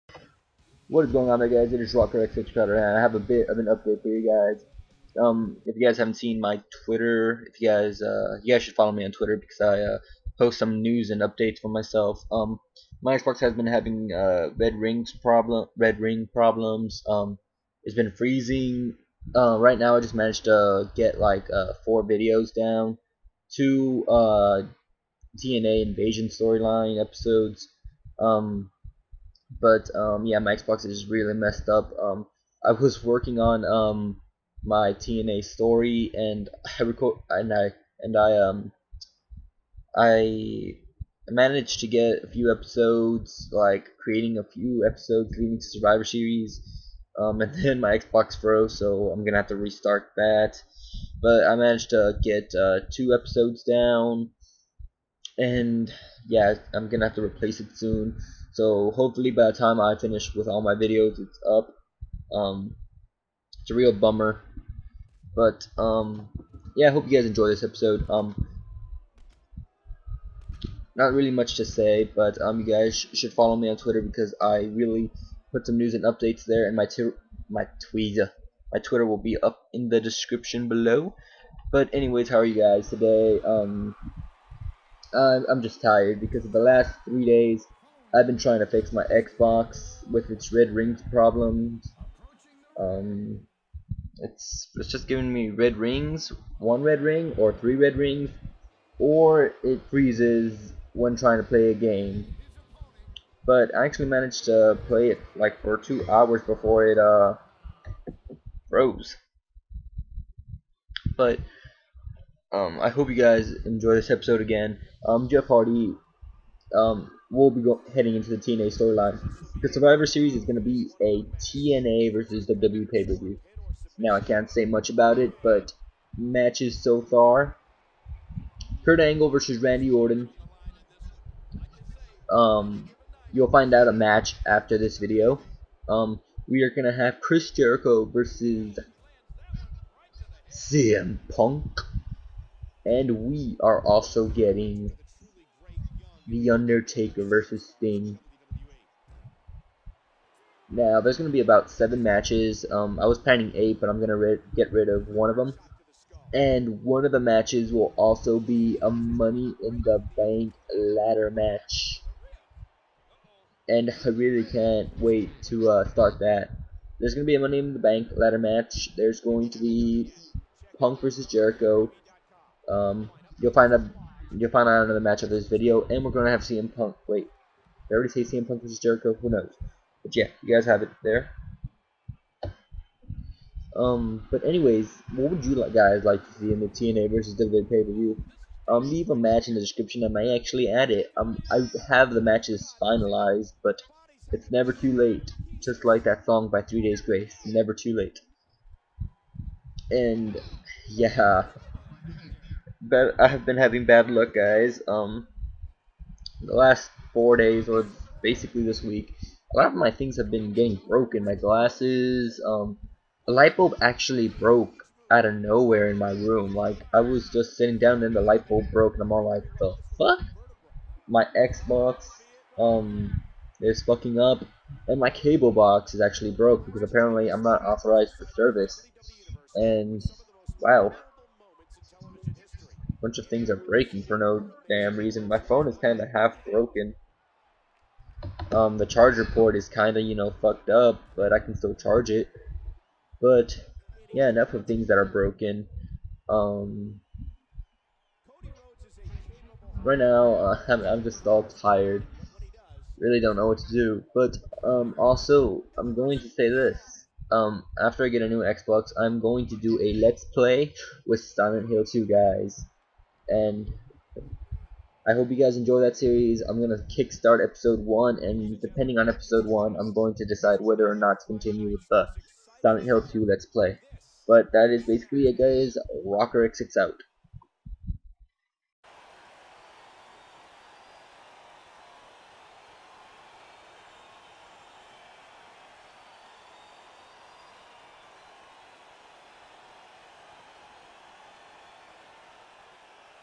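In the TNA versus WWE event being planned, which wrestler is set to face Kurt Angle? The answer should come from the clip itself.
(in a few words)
Randy Orton.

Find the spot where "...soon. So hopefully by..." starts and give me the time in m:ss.
0:57.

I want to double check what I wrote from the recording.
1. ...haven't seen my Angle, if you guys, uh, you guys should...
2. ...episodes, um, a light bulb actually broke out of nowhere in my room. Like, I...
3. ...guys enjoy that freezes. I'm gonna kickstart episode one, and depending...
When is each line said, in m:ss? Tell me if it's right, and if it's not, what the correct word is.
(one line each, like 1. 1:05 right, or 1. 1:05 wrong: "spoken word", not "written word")
1. 0:05 wrong: "Twitter", not "Angle"
2. 3:31 wrong: "glasses", not "episodes"
3. 4:25 wrong: "series", not "freezes".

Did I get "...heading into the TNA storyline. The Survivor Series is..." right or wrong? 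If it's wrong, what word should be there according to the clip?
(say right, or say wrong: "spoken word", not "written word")
right.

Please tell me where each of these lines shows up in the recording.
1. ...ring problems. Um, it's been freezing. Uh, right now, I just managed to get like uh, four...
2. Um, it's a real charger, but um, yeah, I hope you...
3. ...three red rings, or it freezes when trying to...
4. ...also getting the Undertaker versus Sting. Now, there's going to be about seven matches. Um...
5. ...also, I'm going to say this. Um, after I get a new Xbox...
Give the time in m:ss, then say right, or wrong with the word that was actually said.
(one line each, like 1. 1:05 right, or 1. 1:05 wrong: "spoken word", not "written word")
1. 0:16 right
2. 1:02 wrong: "bummer", not "charger"
3. 1:37 right
4. 2:23 right
5. 4:14 right.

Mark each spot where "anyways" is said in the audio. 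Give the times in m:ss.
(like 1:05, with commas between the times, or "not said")
1:21, 3:04.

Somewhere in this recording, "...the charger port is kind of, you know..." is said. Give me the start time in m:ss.
3:58.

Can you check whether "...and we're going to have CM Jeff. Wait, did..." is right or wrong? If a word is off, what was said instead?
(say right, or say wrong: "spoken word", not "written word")
wrong: "Punk", not "Jeff".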